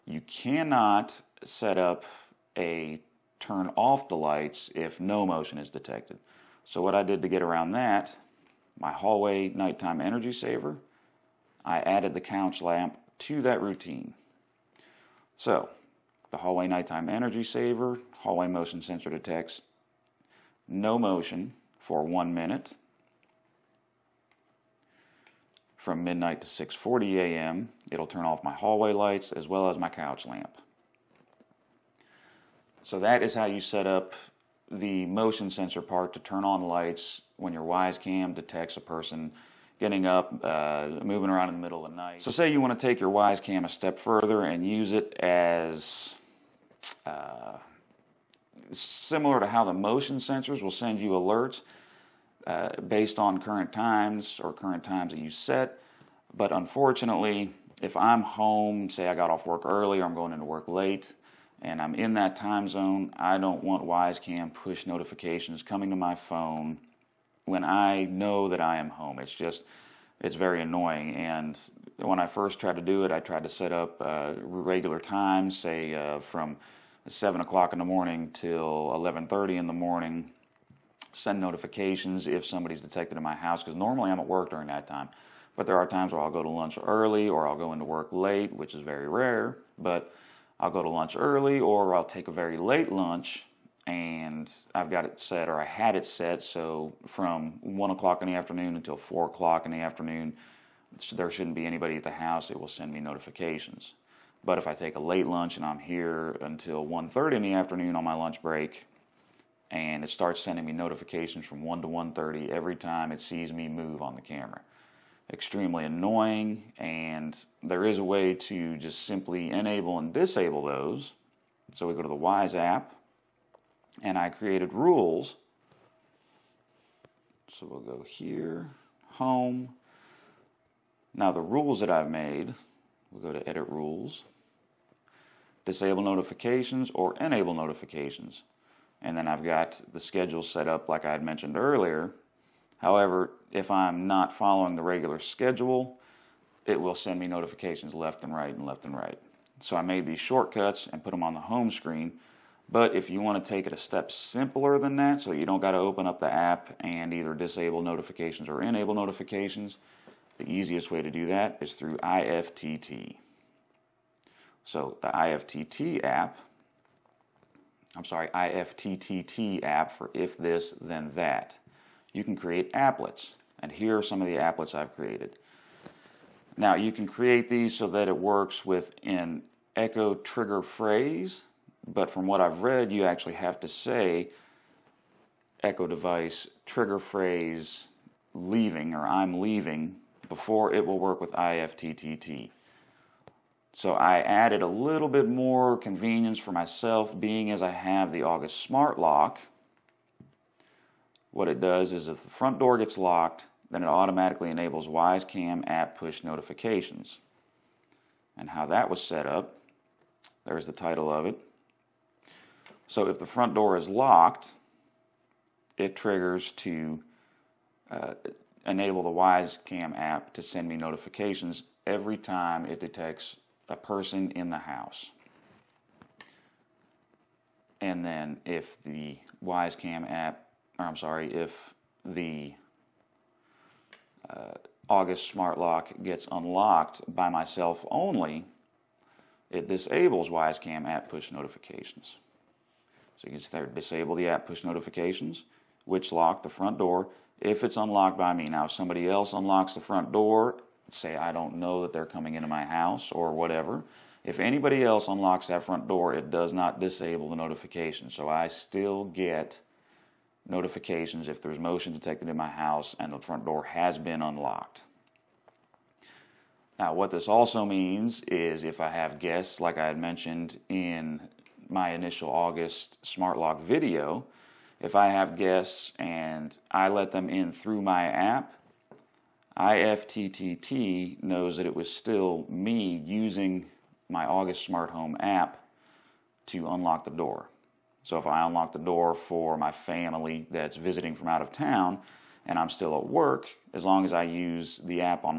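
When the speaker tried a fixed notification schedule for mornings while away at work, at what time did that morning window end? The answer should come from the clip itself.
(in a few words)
11:30 a.m.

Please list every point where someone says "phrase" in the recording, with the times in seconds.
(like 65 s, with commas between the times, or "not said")
180 s, 186 s.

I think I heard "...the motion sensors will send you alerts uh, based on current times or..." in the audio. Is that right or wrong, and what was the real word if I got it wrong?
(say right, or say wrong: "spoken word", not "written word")
right.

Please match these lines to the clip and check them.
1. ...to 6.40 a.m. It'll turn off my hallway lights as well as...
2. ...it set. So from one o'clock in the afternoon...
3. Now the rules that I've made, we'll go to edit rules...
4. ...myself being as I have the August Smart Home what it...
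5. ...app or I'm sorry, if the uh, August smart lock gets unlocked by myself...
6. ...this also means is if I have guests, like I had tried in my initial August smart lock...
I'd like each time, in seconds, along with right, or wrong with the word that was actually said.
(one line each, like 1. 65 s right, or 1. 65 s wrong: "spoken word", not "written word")
1. 26 s right
2. 95 s right
3. 131 s right
4. 196 s wrong: "Lock", not "Home"
5. 230 s right
6. 267 s wrong: "mentioned", not "tried".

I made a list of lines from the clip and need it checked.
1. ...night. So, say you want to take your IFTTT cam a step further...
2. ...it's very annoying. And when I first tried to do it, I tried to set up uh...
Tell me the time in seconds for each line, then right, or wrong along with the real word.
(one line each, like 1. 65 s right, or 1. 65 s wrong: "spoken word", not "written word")
1. 41 s wrong: "Wyze", not "IFTTT"
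2. 70 s right.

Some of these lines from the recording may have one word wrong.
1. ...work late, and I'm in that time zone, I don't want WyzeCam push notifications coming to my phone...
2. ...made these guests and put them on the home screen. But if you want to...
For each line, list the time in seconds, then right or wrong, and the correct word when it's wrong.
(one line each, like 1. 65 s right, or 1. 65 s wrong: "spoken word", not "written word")
1. 60 s right
2. 149 s wrong: "shortcuts", not "guests".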